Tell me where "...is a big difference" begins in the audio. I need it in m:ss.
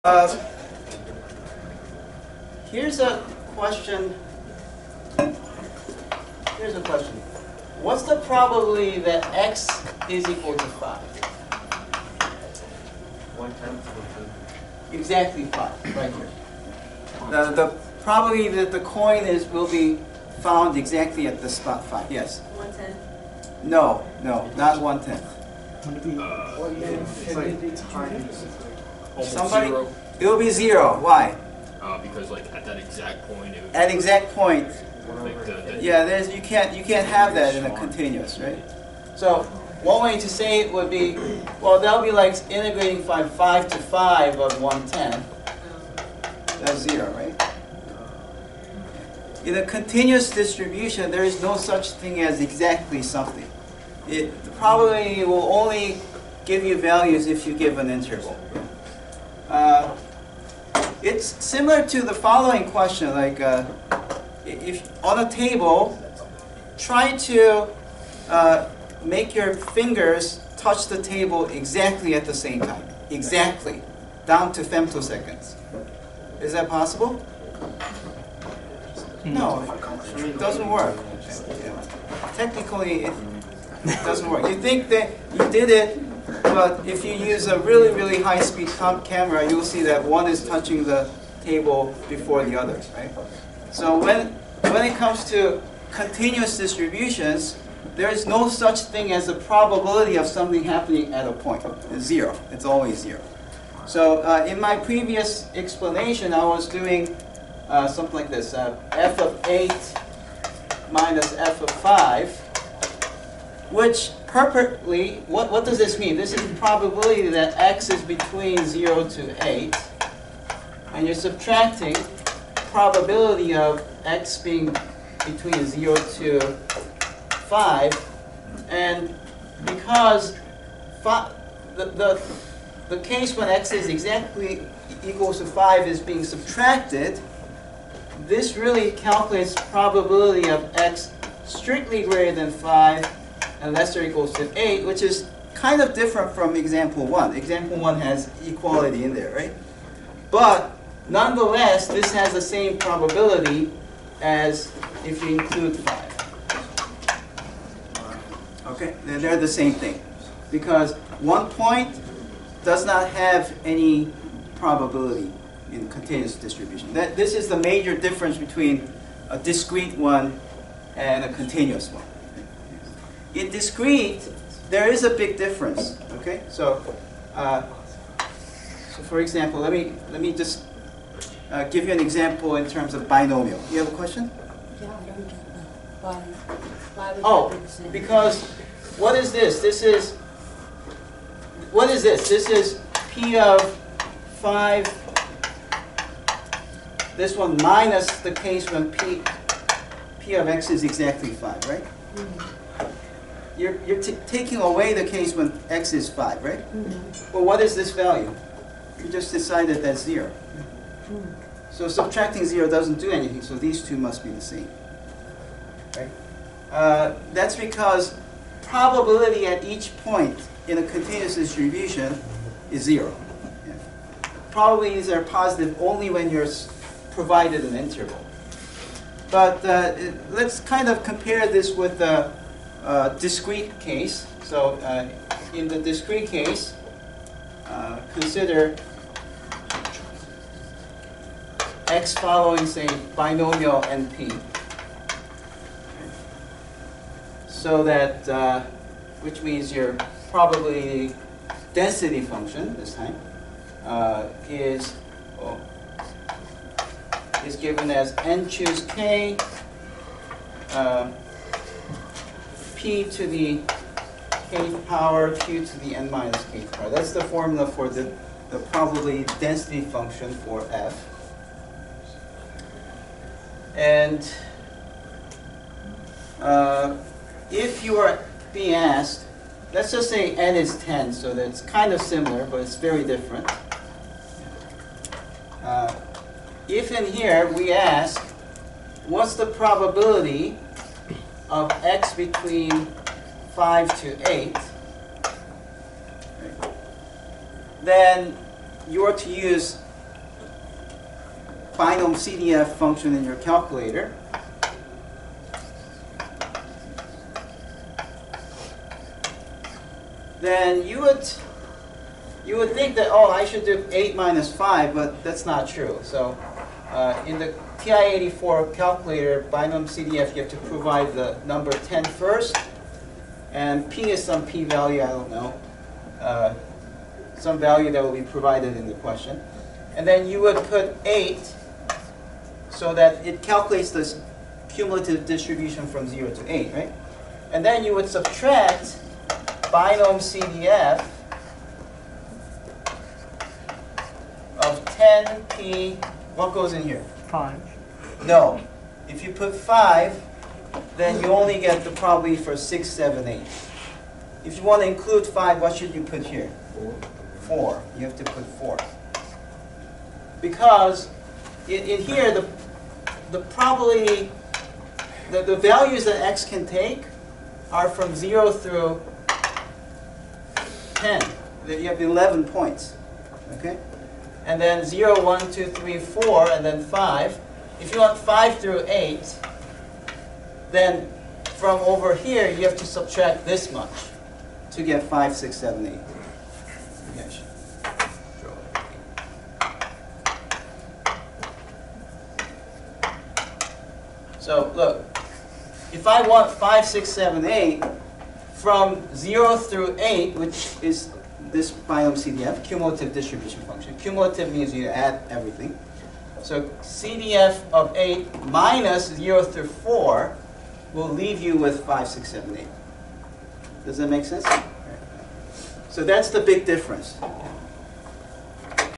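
2:54.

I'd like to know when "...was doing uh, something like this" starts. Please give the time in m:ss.
1:46.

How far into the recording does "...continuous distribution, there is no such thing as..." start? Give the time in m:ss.
0:49.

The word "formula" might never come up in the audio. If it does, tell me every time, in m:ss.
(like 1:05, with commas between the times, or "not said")
4:27.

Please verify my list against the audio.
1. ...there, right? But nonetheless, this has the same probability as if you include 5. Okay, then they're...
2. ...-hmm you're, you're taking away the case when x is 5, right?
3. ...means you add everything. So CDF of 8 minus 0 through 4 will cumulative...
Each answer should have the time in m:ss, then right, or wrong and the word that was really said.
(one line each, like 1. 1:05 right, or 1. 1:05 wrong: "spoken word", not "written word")
1. 2:29 right
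2. 3:22 right
3. 6:44 wrong: "leave", not "cumulative".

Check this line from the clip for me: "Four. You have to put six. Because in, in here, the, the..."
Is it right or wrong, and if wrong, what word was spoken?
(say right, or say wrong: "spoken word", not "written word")
wrong: "four", not "six".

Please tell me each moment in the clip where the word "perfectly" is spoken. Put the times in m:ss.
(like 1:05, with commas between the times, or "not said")
1:54.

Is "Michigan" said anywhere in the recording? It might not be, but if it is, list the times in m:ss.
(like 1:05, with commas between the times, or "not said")
not said.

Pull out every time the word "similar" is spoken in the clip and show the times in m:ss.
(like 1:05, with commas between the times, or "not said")
1:01, 4:42.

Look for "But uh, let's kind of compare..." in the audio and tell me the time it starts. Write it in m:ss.
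3:49.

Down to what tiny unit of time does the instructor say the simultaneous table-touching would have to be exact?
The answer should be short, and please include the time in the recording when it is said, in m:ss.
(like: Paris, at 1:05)
femtoseconds, at 1:14.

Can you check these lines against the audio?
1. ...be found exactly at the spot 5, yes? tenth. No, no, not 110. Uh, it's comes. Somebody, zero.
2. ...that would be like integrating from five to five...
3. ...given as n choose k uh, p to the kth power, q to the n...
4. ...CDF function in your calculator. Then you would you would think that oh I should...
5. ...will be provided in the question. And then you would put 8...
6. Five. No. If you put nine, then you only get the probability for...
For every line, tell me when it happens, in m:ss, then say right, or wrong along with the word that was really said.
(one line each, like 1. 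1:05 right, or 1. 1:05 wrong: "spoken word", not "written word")
1. 0:19 wrong: "times", not "comes"
2. 0:41 right
3. 4:17 right
4. 5:02 right
5. 5:28 right
6. 5:47 wrong: "five", not "nine".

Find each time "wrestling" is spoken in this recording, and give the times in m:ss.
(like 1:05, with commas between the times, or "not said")
not said.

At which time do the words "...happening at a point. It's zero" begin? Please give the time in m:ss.
1:40.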